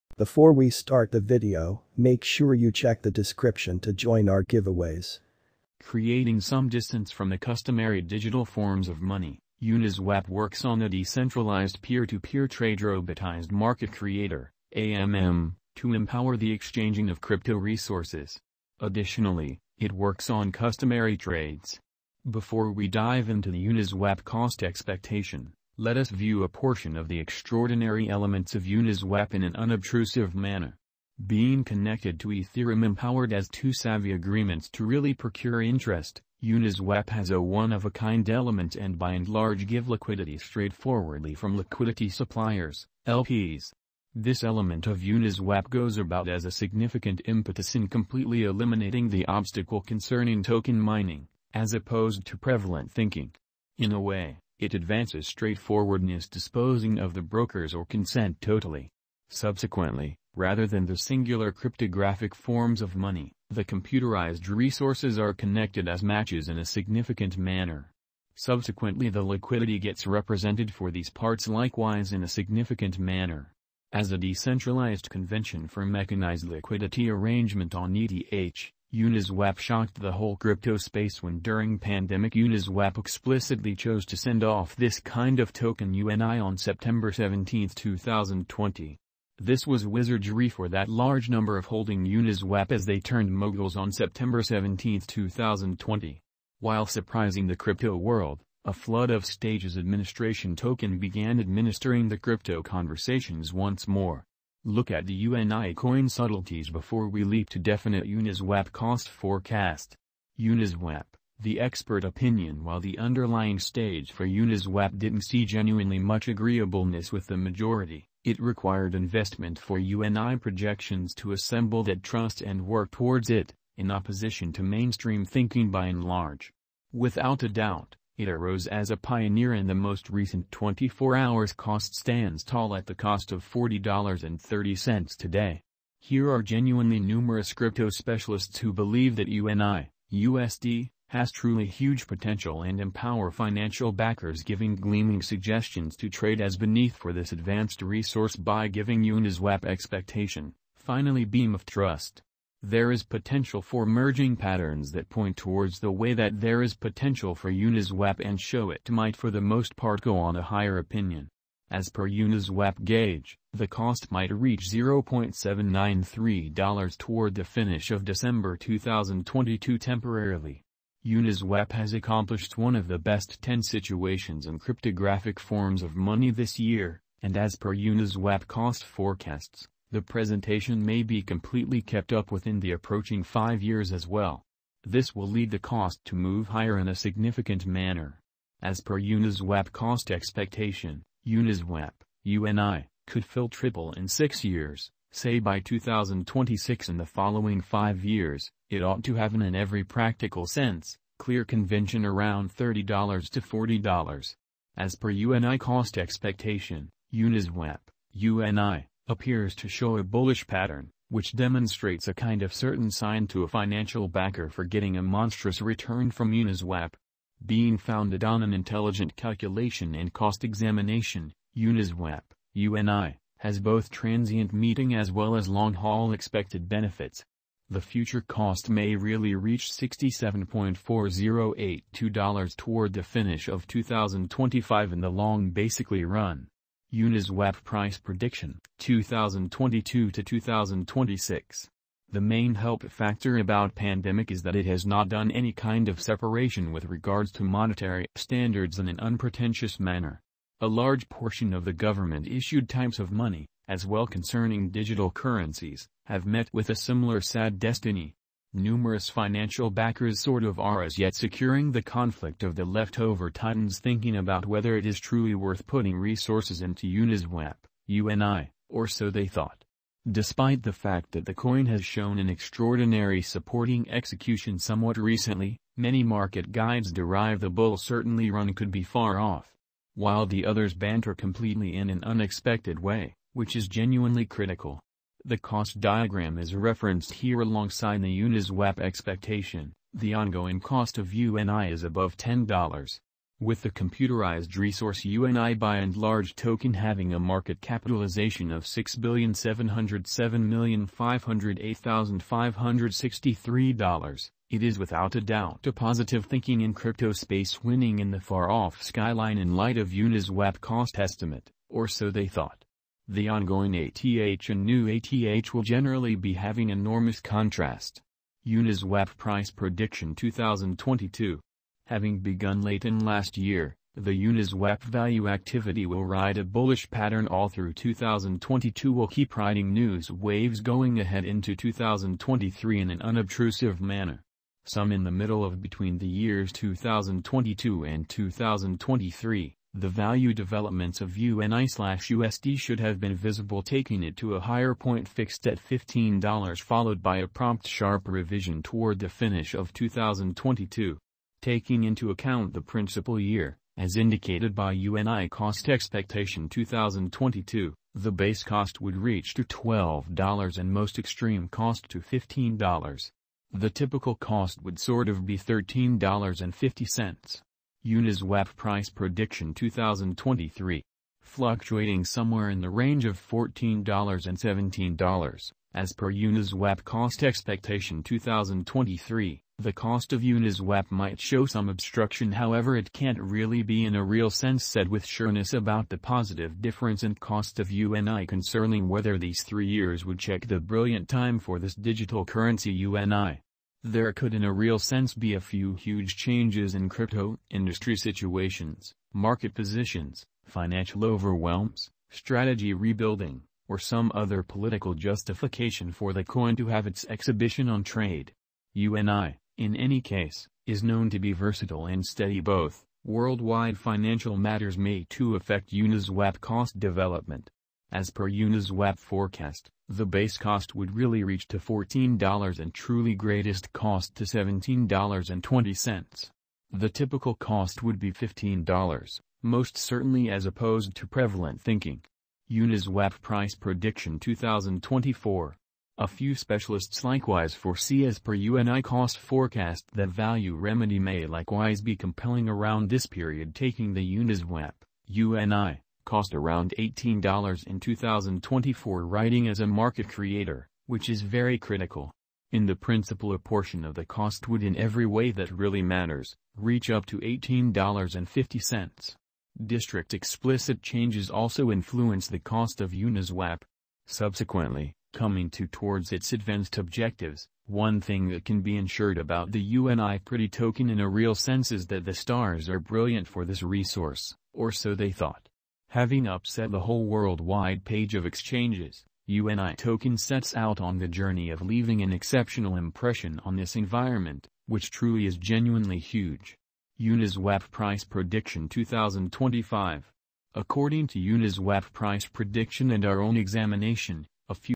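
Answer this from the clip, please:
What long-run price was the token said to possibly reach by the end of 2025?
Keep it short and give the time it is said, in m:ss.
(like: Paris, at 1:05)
$67.4082, at 3:49.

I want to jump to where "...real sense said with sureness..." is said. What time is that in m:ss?
6:24.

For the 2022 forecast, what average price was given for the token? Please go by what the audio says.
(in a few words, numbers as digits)
$13.50.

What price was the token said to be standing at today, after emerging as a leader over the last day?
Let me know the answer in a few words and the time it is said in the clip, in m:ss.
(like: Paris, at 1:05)
$40.30, at 2:13.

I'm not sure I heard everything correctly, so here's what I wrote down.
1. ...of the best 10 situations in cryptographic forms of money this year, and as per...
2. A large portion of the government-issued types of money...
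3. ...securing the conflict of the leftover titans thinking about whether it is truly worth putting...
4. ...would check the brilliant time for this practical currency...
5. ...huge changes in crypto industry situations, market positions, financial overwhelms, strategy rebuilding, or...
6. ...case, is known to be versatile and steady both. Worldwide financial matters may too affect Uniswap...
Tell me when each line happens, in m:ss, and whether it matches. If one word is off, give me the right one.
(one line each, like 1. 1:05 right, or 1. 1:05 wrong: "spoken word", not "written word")
1. 2:52 right
2. 4:10 right
3. 4:21 right
4. 6:30 wrong: "digital", not "practical"
5. 6:35 right
6. 6:49 right.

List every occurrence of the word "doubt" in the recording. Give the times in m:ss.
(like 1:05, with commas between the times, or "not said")
2:07, 5:05.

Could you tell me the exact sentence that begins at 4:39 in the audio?
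While the others banter completely in an unexpected way, which is genuinely critical.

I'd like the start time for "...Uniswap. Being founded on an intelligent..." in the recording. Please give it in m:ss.
3:36.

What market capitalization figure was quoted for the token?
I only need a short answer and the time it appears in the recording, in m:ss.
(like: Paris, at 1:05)
$6,707,508,563, at 4:58.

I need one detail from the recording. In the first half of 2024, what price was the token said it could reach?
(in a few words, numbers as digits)
$18.50.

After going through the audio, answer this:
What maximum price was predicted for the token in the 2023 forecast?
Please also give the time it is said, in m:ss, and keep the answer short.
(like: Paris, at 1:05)
$17.20, at 7:04.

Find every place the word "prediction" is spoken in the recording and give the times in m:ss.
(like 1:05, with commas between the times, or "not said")
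3:57, 5:19, 6:08, 7:13, 8:08, 8:12.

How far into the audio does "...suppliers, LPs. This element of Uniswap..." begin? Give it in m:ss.
0:42.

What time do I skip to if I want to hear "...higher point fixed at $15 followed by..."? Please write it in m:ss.
5:44.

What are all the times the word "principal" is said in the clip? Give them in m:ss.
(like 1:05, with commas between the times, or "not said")
5:52, 7:32.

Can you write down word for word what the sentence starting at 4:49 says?
The ongoing cost of UNI is above $10.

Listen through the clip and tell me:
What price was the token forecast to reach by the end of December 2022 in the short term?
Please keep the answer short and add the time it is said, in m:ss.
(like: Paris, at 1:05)
$0.793, at 2:44.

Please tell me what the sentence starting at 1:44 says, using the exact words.
Look at the UNI coin subtleties before we leap to definite Uniswap cost forecast.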